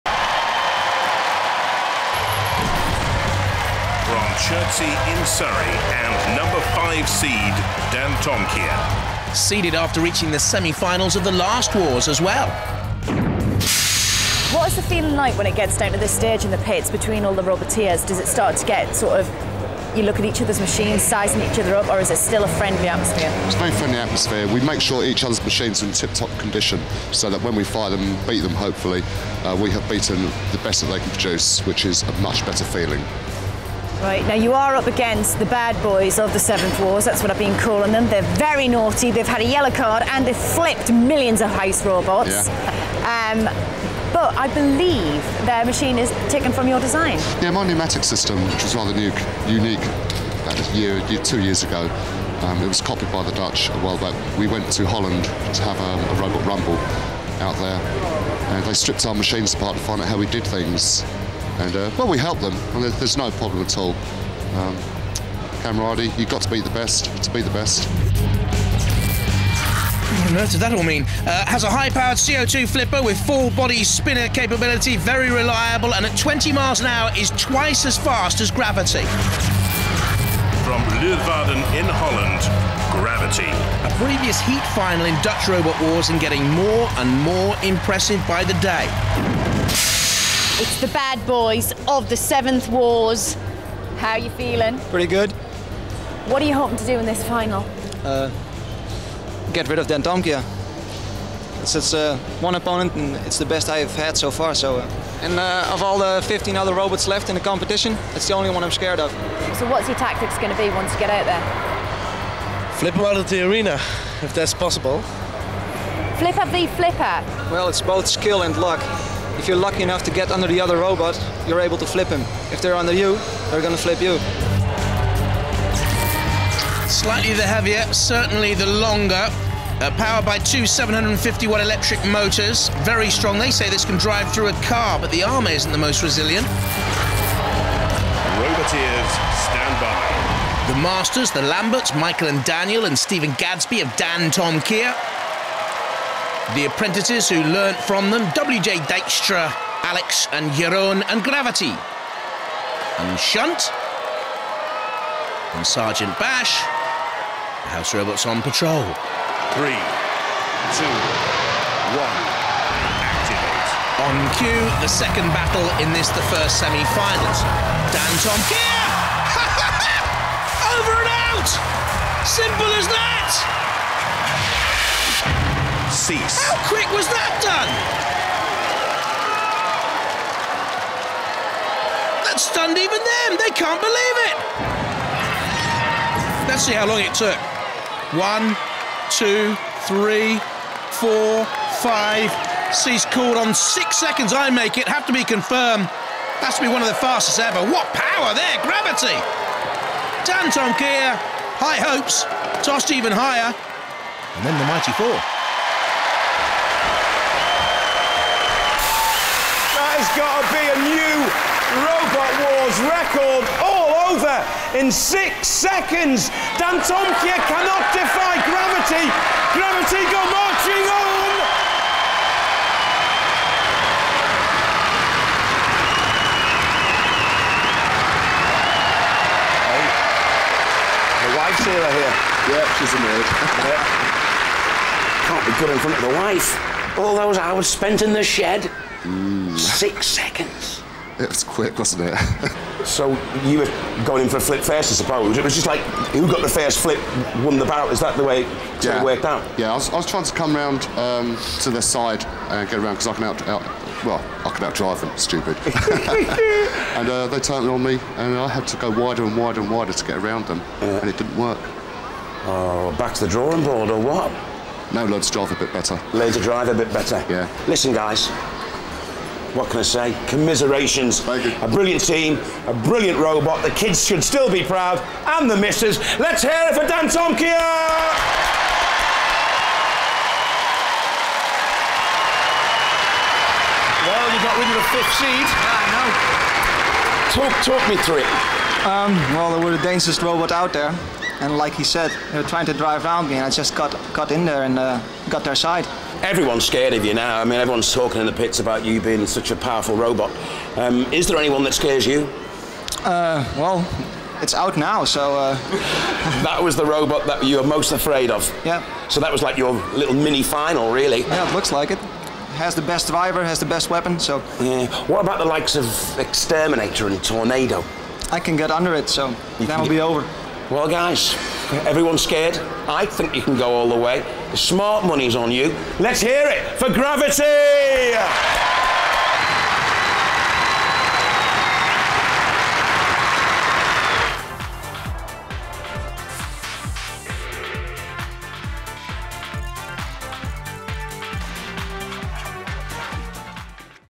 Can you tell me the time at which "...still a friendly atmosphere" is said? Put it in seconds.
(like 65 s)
22 s.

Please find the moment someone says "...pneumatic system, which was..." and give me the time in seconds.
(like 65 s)
47 s.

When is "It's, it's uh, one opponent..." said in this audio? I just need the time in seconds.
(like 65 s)
101 s.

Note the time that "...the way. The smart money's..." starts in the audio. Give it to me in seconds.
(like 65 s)
323 s.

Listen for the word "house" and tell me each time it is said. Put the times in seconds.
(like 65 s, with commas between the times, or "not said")
41 s, 157 s.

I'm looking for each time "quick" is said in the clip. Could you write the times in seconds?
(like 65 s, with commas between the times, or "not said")
176 s, 241 s.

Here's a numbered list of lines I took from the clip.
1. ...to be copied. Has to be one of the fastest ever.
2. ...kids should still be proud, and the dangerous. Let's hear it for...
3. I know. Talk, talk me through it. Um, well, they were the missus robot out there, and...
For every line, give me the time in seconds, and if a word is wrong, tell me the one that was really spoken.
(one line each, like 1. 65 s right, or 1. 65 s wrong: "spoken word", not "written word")
1. 195 s wrong: "confirmed", not "copied"
2. 273 s wrong: "missus", not "dangerous"
3. 285 s wrong: "dangerous", not "missus".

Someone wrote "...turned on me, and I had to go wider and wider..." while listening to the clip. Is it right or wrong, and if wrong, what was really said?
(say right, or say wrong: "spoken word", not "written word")
right.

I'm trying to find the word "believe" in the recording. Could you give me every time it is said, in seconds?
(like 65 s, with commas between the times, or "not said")
44 s, 183 s.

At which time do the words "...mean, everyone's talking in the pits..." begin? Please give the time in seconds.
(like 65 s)
297 s.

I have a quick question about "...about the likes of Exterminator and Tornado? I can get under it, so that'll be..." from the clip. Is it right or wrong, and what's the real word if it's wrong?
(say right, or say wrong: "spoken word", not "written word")
right.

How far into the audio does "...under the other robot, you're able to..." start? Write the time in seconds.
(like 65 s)
120 s.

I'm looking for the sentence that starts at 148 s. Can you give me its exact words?
Dijkstra, Alex and Jeroen and Gravity.